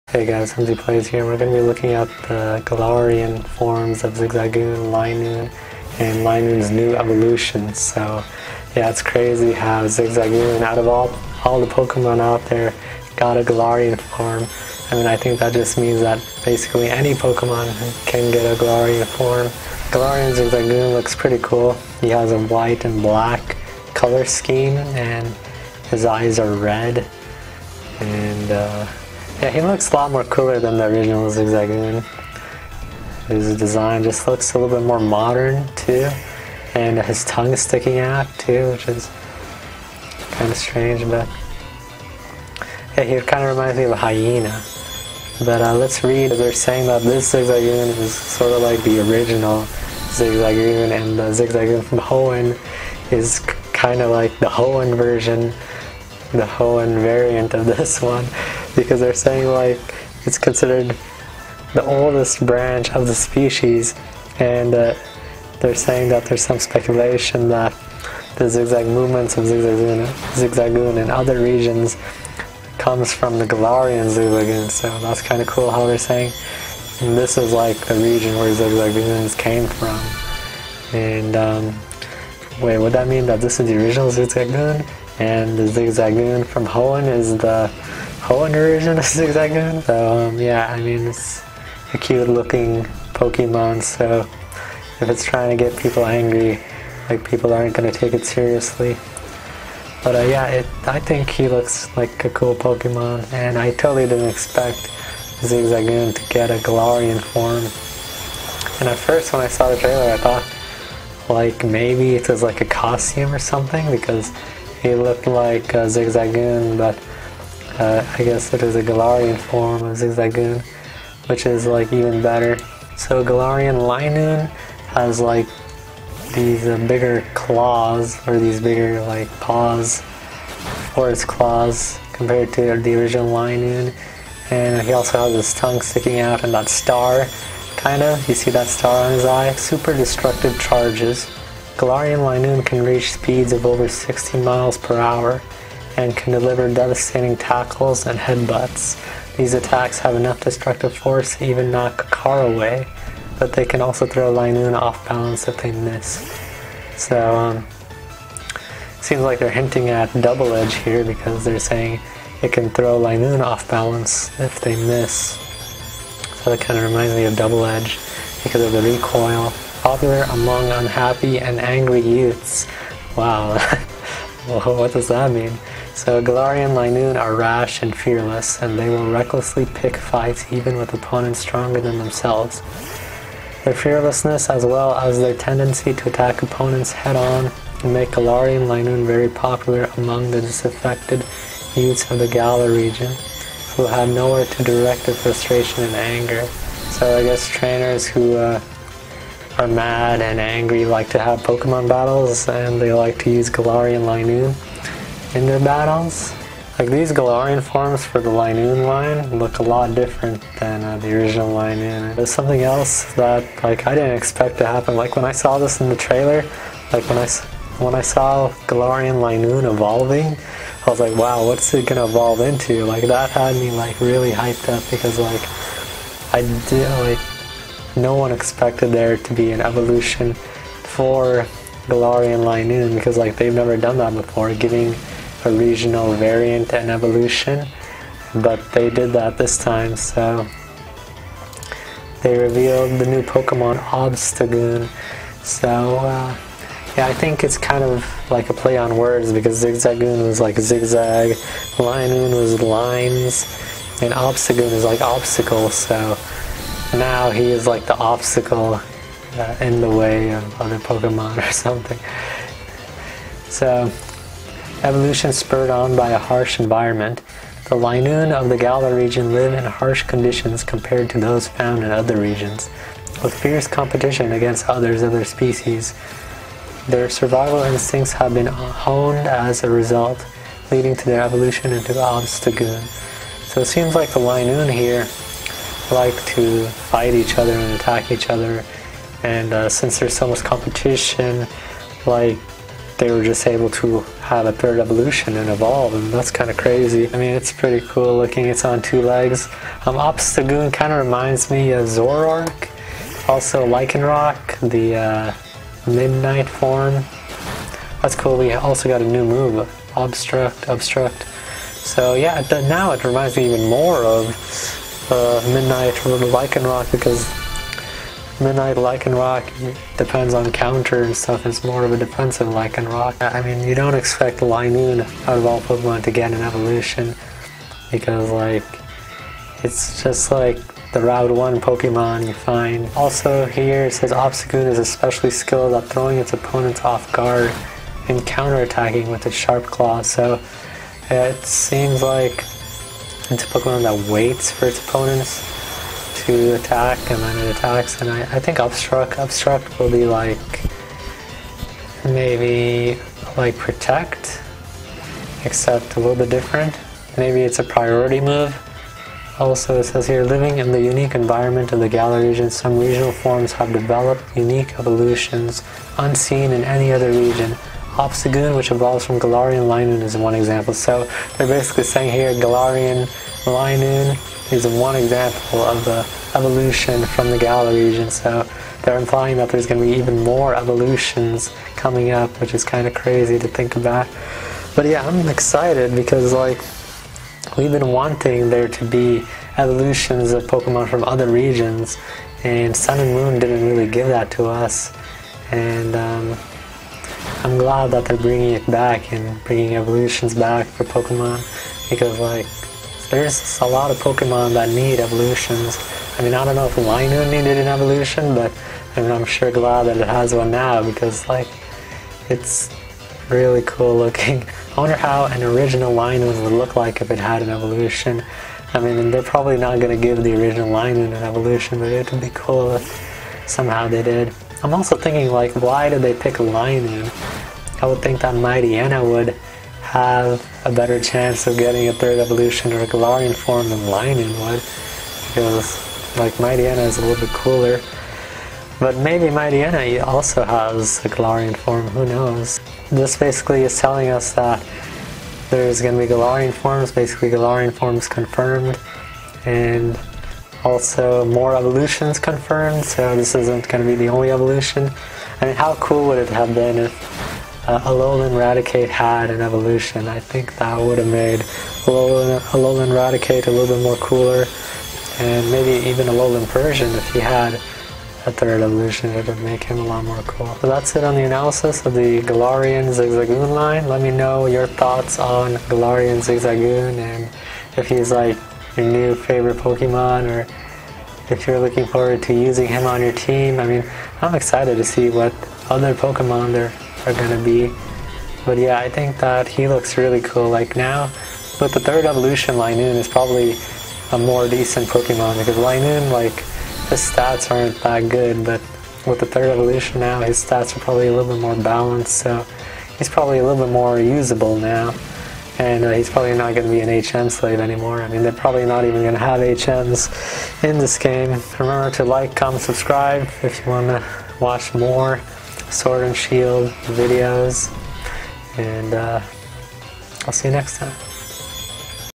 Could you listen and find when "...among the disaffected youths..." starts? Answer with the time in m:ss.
3:09.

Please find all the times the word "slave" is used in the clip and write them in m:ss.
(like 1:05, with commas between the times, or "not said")
8:27.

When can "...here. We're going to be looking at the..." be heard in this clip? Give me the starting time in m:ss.
0:01.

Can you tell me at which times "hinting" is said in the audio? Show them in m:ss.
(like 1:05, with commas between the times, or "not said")
2:39.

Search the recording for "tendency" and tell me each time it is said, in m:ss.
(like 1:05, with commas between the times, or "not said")
3:05.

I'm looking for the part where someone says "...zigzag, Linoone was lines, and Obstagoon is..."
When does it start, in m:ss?
4:10.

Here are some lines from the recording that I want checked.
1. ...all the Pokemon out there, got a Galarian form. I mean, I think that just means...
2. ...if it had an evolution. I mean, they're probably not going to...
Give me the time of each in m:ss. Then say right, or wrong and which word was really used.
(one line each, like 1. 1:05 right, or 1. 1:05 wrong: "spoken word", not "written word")
1. 0:11 right
2. 6:57 right.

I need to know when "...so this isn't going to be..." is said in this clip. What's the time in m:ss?
7:32.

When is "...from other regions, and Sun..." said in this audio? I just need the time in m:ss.
6:30.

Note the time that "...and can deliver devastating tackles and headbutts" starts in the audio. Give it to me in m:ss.
2:26.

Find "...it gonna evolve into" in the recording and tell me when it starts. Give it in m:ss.
3:41.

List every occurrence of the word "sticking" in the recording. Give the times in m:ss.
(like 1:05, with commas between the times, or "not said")
0:37, 2:15.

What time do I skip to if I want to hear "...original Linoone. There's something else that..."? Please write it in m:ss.
3:31.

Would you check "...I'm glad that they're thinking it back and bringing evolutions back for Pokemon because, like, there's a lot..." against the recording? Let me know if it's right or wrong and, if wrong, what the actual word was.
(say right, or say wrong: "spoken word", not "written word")
wrong: "bringing", not "thinking".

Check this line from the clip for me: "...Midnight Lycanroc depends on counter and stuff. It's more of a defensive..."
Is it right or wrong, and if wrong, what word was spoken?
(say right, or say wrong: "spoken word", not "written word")
right.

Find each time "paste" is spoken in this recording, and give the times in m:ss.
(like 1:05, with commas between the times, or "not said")
not said.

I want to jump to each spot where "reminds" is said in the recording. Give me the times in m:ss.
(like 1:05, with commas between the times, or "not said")
0:43, 2:46, 5:01, 5:13.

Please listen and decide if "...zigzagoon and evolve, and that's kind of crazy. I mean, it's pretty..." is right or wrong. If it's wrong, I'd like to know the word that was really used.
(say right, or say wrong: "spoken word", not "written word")
wrong: "evolution", not "zigzagoon".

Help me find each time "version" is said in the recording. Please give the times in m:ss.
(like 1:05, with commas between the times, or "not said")
0:54, 1:28.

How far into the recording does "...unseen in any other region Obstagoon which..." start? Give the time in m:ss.
6:05.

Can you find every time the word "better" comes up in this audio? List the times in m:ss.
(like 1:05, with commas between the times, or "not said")
2:02, 7:10.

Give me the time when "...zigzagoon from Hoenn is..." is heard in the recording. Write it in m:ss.
1:25.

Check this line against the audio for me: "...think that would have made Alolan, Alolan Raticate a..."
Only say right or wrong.
right.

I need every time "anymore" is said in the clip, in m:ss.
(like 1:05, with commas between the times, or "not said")
8:27.